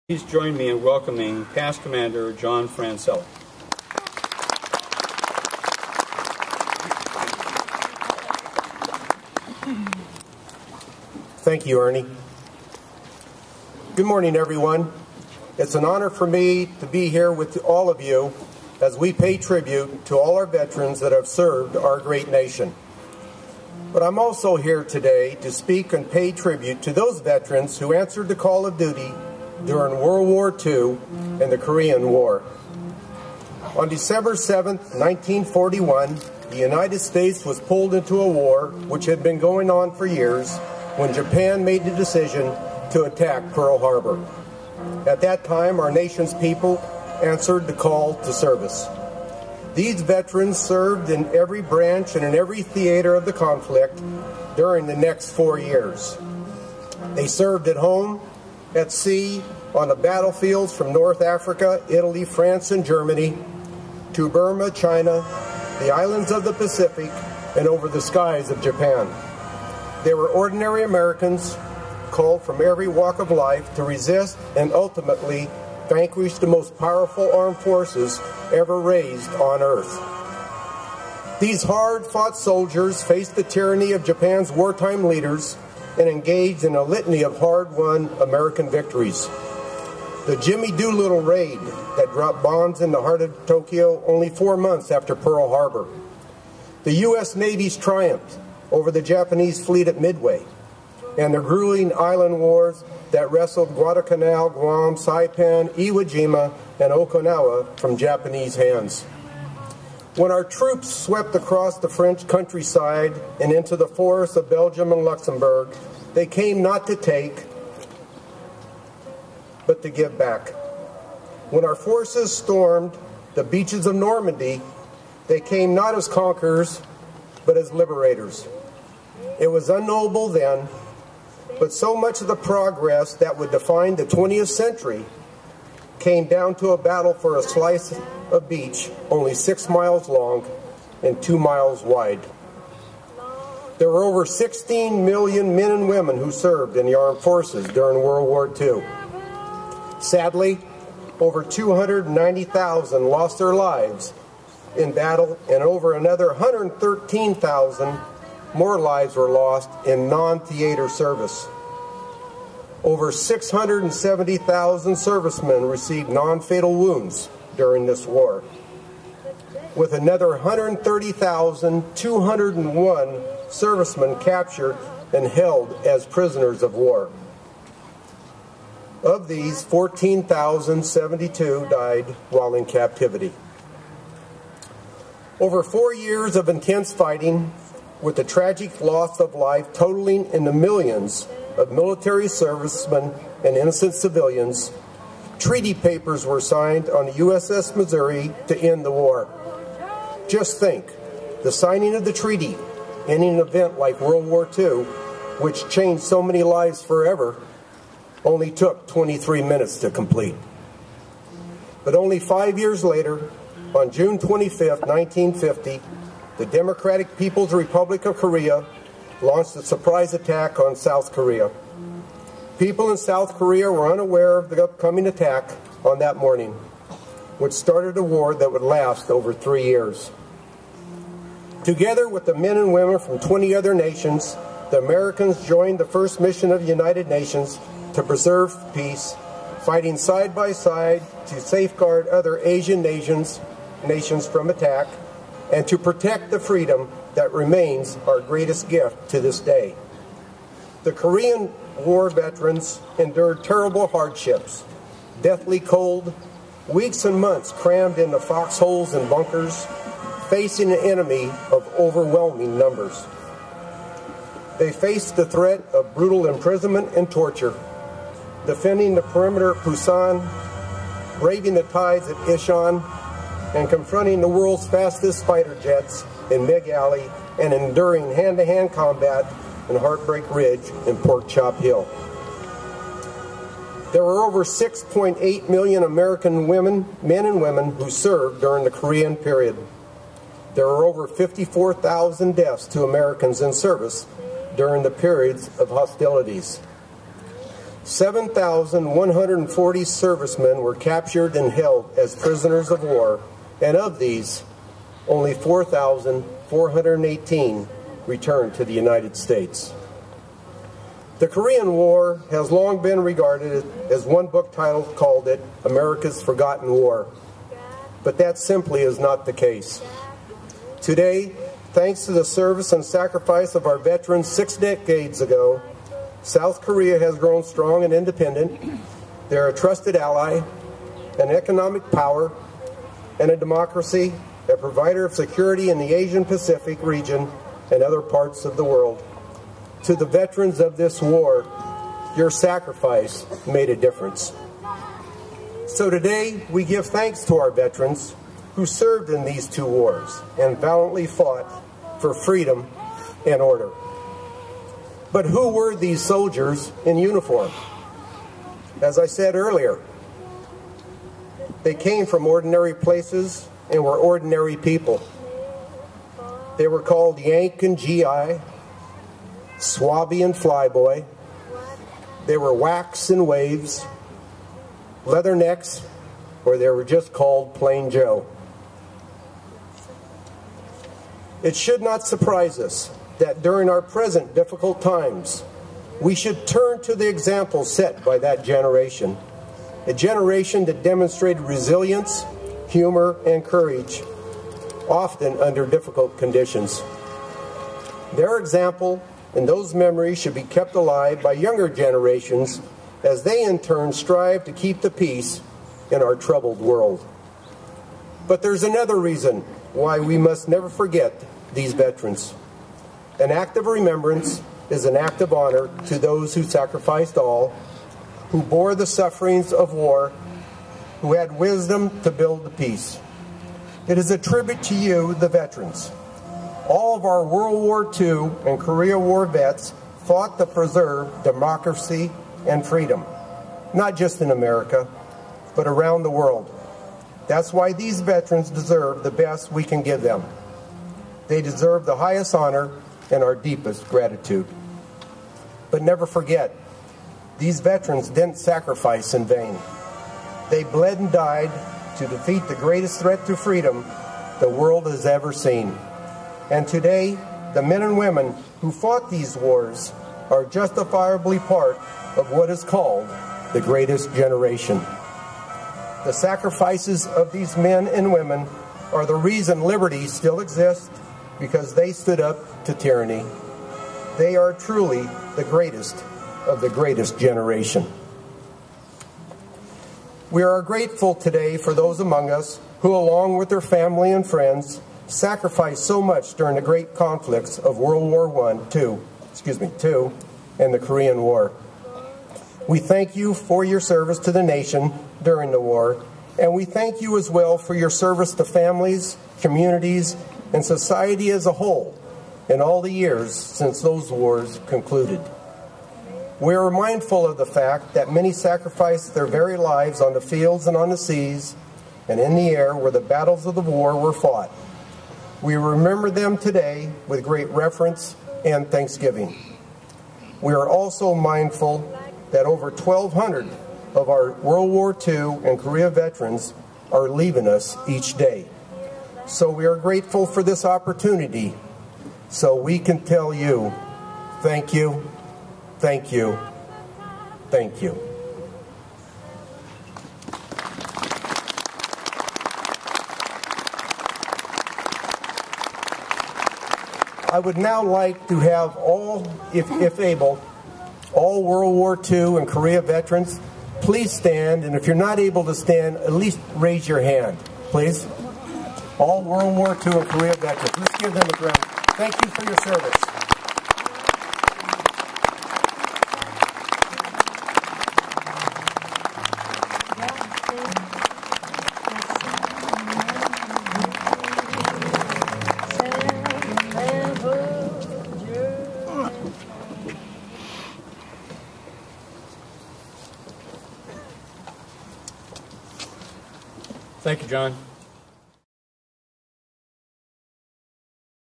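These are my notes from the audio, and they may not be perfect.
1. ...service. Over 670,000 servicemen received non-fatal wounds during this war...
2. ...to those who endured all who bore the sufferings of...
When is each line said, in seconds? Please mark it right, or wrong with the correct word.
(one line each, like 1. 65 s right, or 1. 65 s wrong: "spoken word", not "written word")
1. 160 s right
2. 415 s wrong: "sacrificed", not "endured".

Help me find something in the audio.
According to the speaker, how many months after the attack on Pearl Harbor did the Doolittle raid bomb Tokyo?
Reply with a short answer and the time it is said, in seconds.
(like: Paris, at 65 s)
4, at 94 s.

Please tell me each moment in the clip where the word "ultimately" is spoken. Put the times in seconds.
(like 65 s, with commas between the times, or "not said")
74 s.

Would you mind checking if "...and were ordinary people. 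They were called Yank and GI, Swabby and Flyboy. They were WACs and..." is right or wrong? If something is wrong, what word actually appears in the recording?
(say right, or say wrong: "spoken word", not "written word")
right.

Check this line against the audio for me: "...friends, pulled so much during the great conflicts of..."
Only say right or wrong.
wrong.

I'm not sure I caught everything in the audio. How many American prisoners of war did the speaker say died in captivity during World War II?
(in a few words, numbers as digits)
14,072.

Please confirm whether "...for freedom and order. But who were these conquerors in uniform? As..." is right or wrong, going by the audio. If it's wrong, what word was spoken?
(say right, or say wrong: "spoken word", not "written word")
wrong: "soldiers", not "conquerors".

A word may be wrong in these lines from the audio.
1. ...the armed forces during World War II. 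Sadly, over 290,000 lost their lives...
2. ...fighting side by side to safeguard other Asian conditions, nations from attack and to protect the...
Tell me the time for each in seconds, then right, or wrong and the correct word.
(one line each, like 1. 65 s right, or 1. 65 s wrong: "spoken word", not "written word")
1. 146 s right
2. 239 s wrong: "nations", not "conditions".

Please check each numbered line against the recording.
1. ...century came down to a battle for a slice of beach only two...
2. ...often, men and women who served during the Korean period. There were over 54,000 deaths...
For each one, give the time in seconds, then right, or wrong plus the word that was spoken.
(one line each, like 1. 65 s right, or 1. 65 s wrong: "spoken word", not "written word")
1. 134 s wrong: "six", not "two"
2. 286 s wrong: "women", not "often".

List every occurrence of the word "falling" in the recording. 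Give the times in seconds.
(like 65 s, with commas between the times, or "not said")
not said.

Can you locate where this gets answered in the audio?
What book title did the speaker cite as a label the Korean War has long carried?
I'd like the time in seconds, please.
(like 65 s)
315 s.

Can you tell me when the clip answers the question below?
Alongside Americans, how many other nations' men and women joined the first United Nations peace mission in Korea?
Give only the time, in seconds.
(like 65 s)
233 s.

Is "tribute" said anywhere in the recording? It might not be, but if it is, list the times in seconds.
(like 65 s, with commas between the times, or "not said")
19 s, 26 s, 424 s.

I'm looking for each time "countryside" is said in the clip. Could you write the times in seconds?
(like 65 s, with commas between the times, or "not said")
112 s.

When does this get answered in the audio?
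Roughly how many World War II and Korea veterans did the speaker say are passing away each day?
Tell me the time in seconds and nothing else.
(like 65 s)
522 s.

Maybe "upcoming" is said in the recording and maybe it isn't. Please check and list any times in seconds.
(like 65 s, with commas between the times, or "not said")
224 s.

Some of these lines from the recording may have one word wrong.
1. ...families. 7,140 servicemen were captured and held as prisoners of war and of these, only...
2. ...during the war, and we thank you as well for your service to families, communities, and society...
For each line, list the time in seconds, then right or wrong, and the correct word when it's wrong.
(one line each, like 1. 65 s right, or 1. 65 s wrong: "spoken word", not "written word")
1. 295 s wrong: "hostilities", not "families"
2. 495 s right.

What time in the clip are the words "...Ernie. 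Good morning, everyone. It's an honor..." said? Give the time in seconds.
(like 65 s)
11 s.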